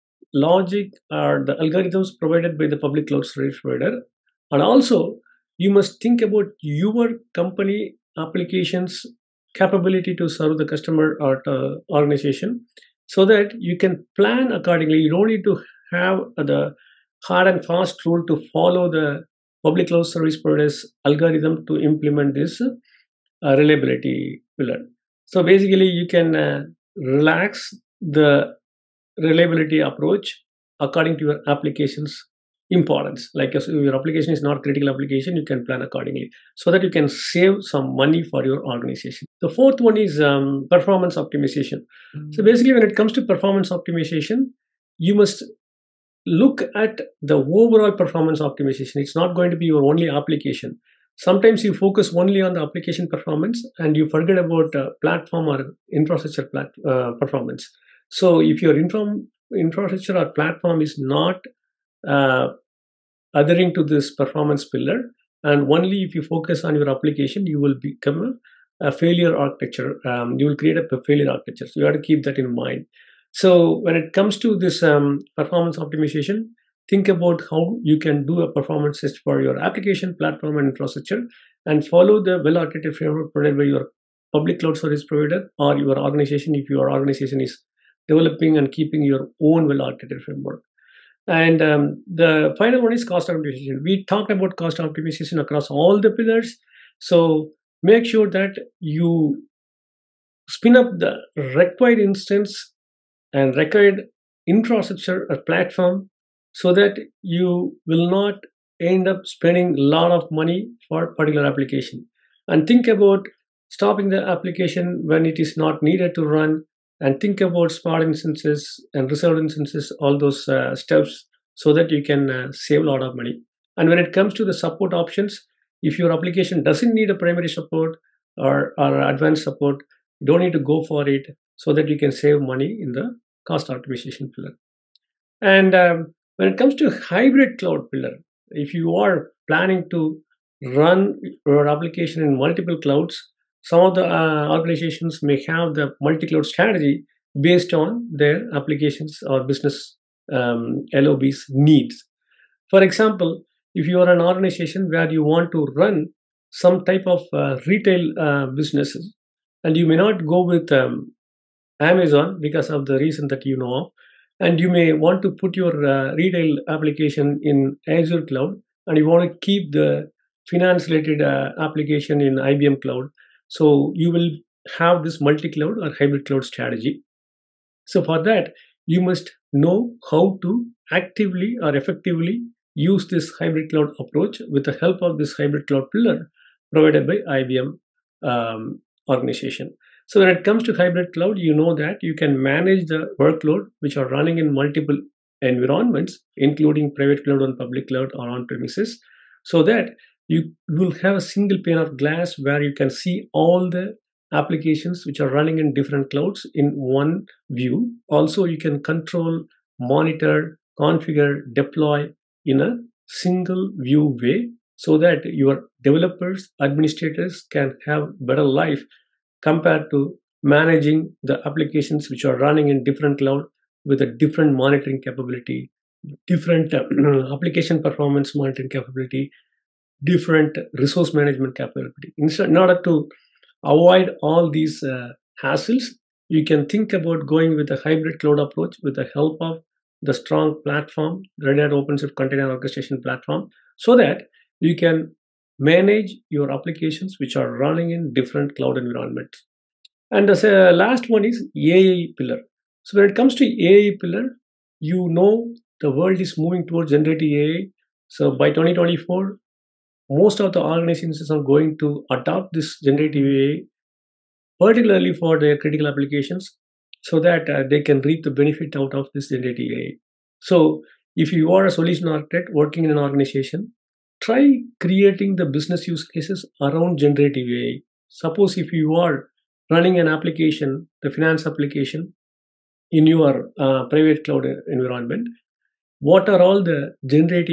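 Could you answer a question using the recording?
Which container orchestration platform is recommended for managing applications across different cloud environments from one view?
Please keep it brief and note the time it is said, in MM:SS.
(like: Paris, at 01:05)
Red Hat OpenShift, at 04:01.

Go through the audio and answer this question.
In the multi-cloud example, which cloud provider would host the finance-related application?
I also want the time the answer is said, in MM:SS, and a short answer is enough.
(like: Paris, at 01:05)
IBM Cloud, at 02:52.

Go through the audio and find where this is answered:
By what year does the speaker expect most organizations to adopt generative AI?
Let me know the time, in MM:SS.
04:18.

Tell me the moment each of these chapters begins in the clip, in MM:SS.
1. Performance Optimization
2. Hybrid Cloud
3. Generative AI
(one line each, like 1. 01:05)
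1. 00:41
2. 02:14
3. 04:09.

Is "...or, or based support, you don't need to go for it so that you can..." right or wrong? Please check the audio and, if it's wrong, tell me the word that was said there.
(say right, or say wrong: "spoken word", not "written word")
wrong: "advanced", not "based".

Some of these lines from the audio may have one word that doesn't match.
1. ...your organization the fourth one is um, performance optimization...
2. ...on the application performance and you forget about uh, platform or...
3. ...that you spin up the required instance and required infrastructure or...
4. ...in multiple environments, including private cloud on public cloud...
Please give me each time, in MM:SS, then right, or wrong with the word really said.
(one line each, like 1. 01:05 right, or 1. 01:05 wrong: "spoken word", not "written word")
1. 00:38 right
2. 00:52 right
3. 01:38 right
4. 03:14 right.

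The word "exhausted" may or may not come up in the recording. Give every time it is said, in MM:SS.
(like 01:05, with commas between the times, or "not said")
not said.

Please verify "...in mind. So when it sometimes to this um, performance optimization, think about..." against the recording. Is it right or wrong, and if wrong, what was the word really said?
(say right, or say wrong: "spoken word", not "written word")
wrong: "comes", not "sometimes".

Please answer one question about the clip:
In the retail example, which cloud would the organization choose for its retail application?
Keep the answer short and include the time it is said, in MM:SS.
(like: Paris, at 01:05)
Azure Cloud, at 02:47.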